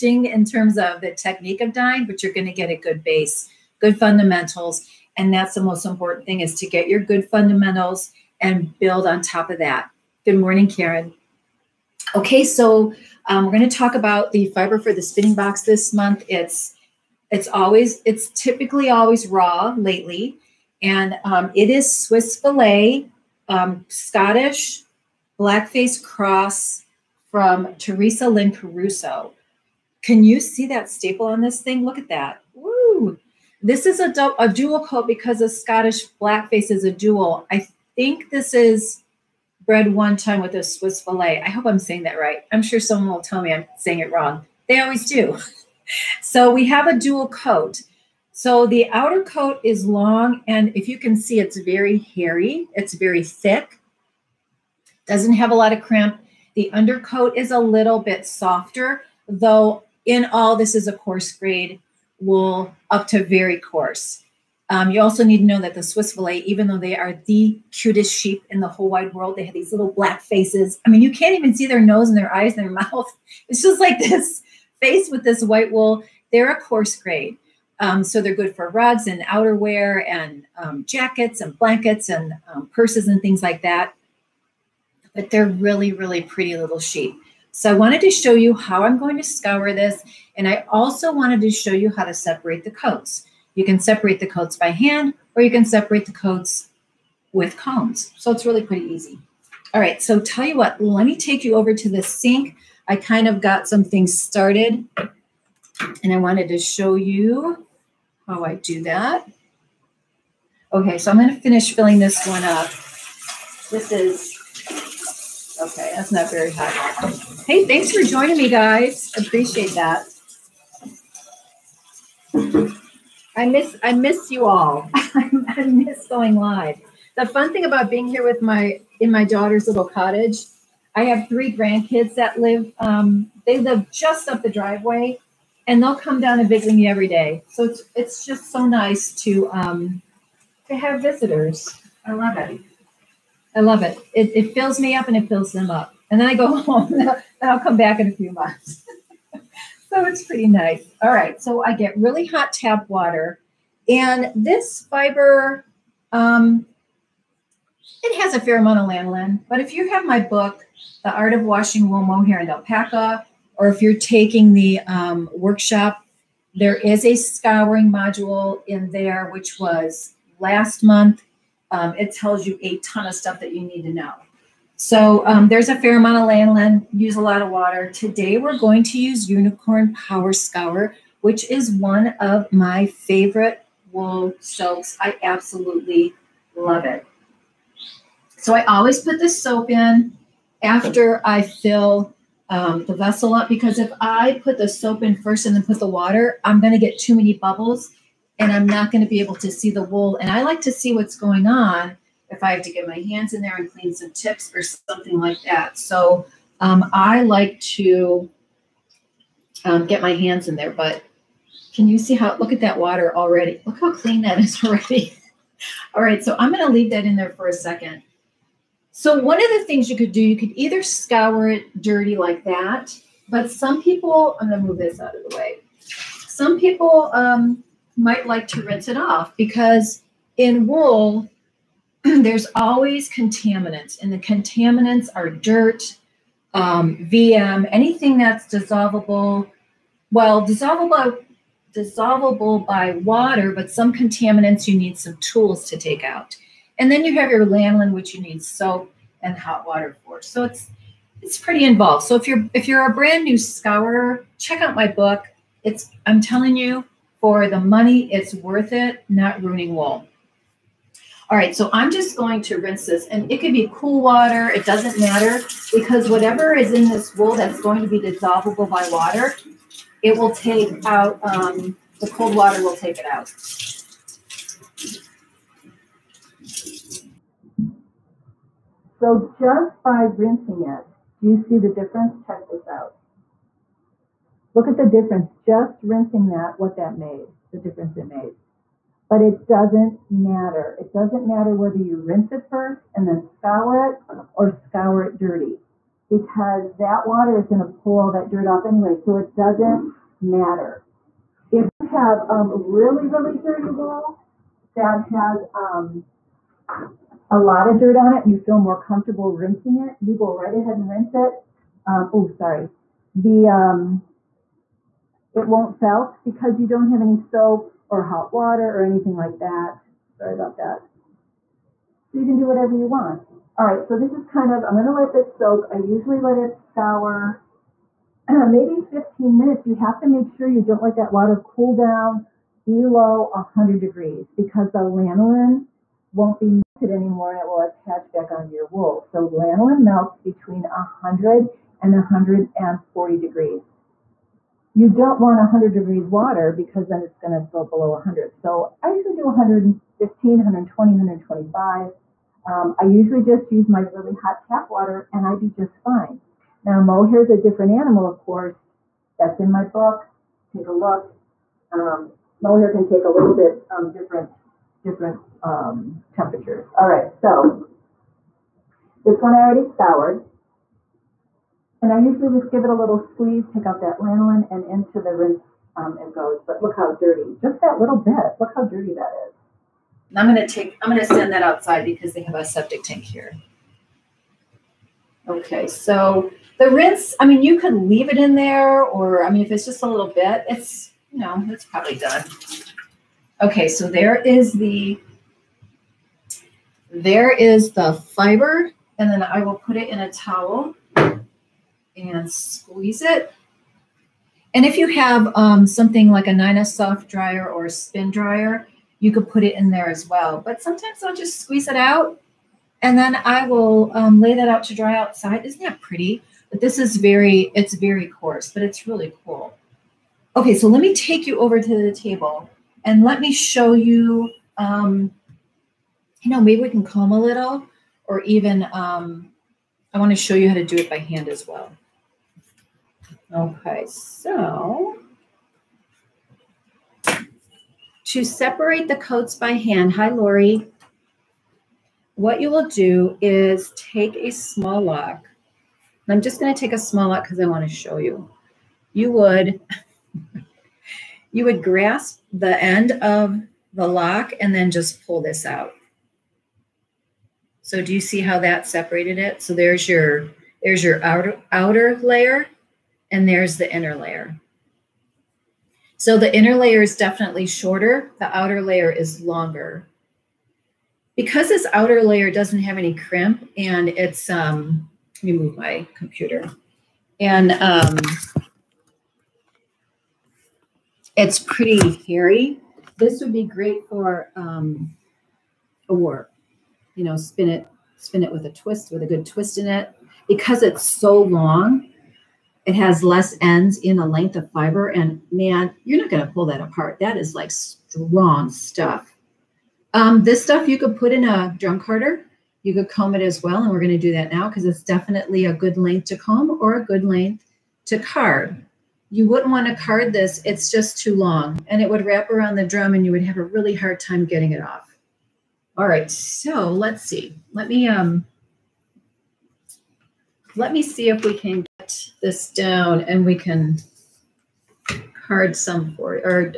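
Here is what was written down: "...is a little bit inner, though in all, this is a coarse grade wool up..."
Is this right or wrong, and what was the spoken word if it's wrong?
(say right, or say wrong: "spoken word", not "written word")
wrong: "softer", not "inner".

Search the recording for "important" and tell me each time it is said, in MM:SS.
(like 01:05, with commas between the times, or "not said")
00:05.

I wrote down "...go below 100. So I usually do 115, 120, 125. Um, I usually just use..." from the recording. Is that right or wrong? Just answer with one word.
right.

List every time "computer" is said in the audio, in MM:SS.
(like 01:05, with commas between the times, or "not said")
07:55.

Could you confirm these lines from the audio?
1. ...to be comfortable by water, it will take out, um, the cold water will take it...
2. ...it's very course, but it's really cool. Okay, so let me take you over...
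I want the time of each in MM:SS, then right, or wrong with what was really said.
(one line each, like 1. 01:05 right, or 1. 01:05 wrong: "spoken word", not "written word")
1. 04:27 wrong: "dissolvable", not "comfortable"
2. 06:57 wrong: "coarse", not "course".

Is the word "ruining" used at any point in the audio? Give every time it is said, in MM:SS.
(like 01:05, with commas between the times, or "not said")
04:19.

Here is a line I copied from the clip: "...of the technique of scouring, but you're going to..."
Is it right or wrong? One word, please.
wrong.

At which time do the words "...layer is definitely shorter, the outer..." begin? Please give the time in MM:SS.
07:46.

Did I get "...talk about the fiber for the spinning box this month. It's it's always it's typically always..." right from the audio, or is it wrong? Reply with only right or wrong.
right.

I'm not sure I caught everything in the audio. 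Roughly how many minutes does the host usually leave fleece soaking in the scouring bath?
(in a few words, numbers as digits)
15.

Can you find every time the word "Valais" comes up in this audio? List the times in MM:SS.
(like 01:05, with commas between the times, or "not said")
00:22, 00:41, 01:06.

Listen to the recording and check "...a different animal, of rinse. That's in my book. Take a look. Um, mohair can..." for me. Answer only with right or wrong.
wrong.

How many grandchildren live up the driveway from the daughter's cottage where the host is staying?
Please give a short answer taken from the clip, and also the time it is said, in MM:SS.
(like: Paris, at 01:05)
3, at 02:11.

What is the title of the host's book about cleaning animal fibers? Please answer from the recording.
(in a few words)
The Art of Washing Wool, Mohair, and Alpaca.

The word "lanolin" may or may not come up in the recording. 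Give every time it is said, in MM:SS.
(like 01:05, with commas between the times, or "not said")
02:38, 04:07, 05:34, 05:39, 06:13.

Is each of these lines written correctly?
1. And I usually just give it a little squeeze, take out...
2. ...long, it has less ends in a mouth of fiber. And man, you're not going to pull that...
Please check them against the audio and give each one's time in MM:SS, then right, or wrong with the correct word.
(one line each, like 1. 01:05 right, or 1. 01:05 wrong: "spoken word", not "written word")
1. 06:11 right
2. 08:11 wrong: "length", not "mouth".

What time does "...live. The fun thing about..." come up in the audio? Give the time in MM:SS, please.
02:06.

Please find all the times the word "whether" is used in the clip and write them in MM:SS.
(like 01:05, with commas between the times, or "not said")
04:51.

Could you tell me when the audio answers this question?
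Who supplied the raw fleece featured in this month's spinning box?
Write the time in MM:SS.
00:27.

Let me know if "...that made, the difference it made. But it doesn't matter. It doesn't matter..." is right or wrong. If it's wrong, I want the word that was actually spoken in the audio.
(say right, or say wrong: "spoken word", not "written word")
right.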